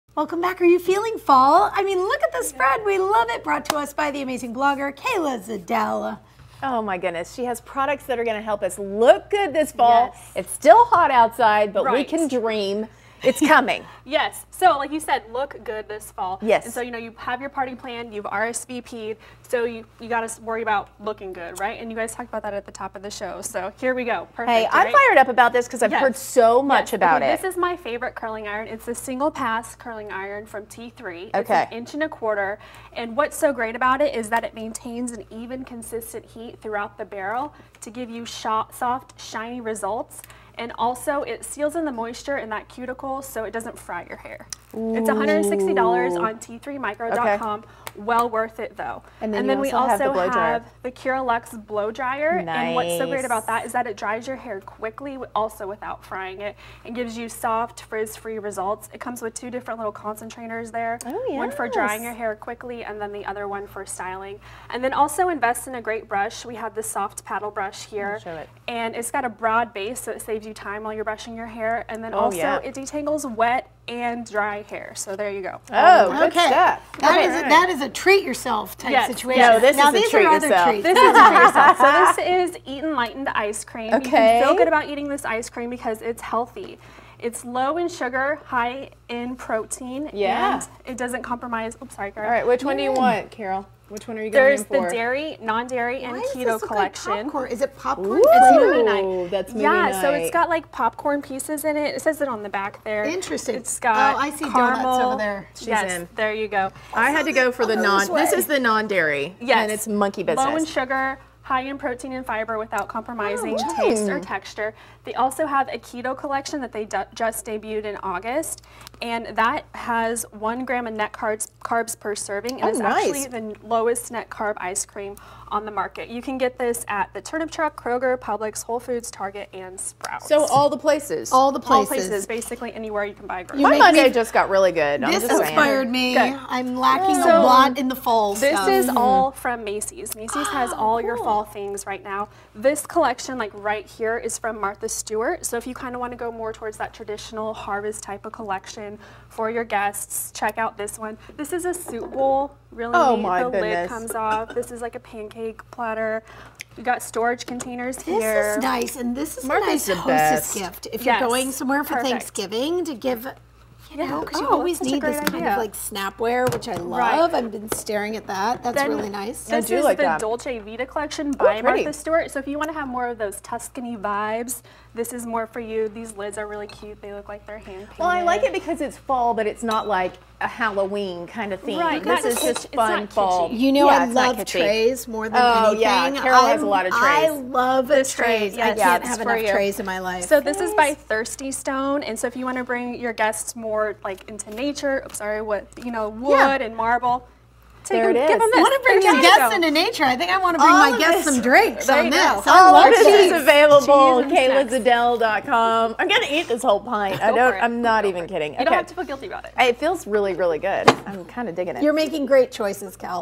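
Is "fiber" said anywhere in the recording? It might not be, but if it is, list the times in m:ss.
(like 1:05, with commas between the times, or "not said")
1:52.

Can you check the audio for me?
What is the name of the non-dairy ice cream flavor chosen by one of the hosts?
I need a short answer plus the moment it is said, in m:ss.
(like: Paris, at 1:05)
Monkey Business, at 1:49.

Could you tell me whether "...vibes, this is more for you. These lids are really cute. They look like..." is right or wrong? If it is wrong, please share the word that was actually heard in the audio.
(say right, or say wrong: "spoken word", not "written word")
right.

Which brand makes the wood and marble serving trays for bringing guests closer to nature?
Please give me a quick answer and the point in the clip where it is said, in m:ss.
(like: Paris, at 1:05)
Thirsty Stone, at 3:10.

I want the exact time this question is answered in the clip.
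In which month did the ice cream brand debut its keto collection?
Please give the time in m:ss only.
1:58.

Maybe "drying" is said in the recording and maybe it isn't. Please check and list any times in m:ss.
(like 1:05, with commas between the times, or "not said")
1:01.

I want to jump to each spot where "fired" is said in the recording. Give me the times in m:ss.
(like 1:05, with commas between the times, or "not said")
0:24.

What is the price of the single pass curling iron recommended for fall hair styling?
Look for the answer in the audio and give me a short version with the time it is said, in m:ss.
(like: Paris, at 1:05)
$160, at 0:45.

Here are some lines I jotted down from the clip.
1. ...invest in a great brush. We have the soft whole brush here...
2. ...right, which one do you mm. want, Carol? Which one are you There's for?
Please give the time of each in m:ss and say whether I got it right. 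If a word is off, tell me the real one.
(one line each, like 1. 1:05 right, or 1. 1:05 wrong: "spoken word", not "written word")
1. 1:05 wrong: "paddle", not "whole"
2. 1:32 right.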